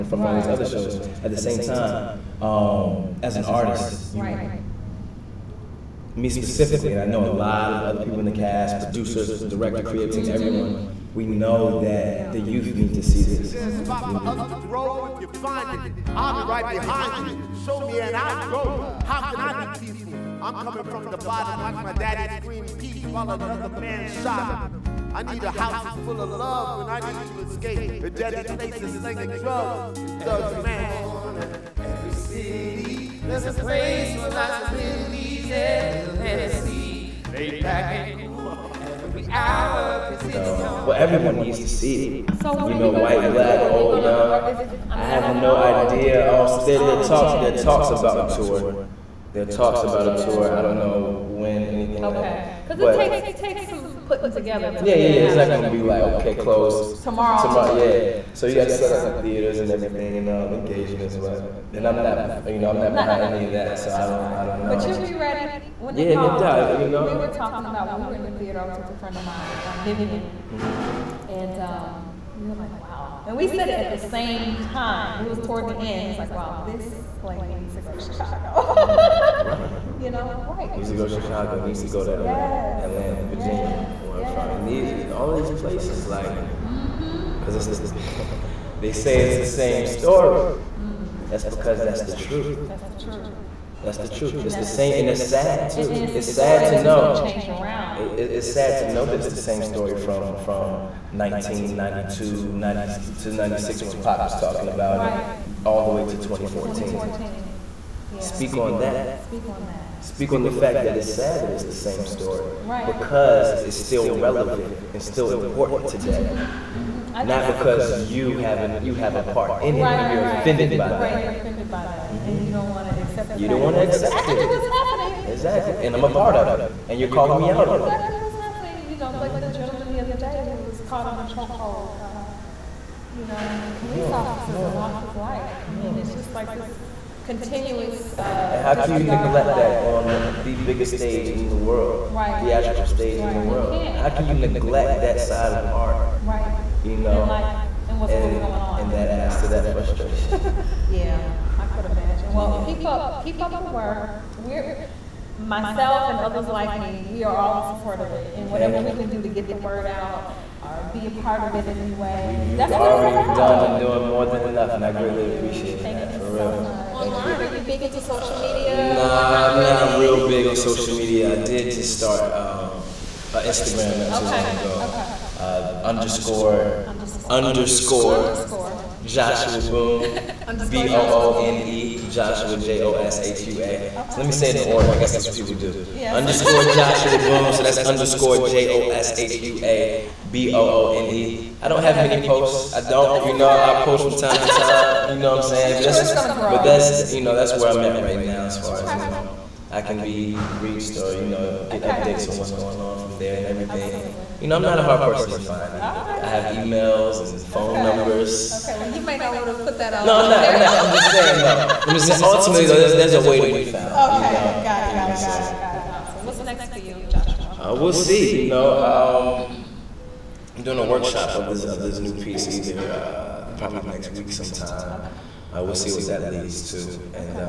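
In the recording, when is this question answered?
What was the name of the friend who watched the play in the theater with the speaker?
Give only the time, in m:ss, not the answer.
1:09.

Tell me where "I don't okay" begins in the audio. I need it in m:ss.
3:11.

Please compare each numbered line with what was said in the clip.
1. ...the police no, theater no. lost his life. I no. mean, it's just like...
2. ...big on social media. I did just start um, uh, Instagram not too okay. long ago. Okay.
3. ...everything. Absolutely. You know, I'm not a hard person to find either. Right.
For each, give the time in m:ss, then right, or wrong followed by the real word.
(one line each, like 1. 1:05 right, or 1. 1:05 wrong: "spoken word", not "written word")
1. 2:13 wrong: "officer", not "theater"
2. 2:50 right
3. 3:23 right.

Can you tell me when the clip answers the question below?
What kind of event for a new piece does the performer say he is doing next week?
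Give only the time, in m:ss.
3:40.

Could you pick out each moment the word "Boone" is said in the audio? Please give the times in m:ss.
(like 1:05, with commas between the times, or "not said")
2:59, 3:07.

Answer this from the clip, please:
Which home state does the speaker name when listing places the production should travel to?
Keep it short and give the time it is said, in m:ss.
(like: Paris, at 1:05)
Virginia, at 1:23.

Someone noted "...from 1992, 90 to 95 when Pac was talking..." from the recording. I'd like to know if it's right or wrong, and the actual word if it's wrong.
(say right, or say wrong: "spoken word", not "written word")
wrong: "96", not "95".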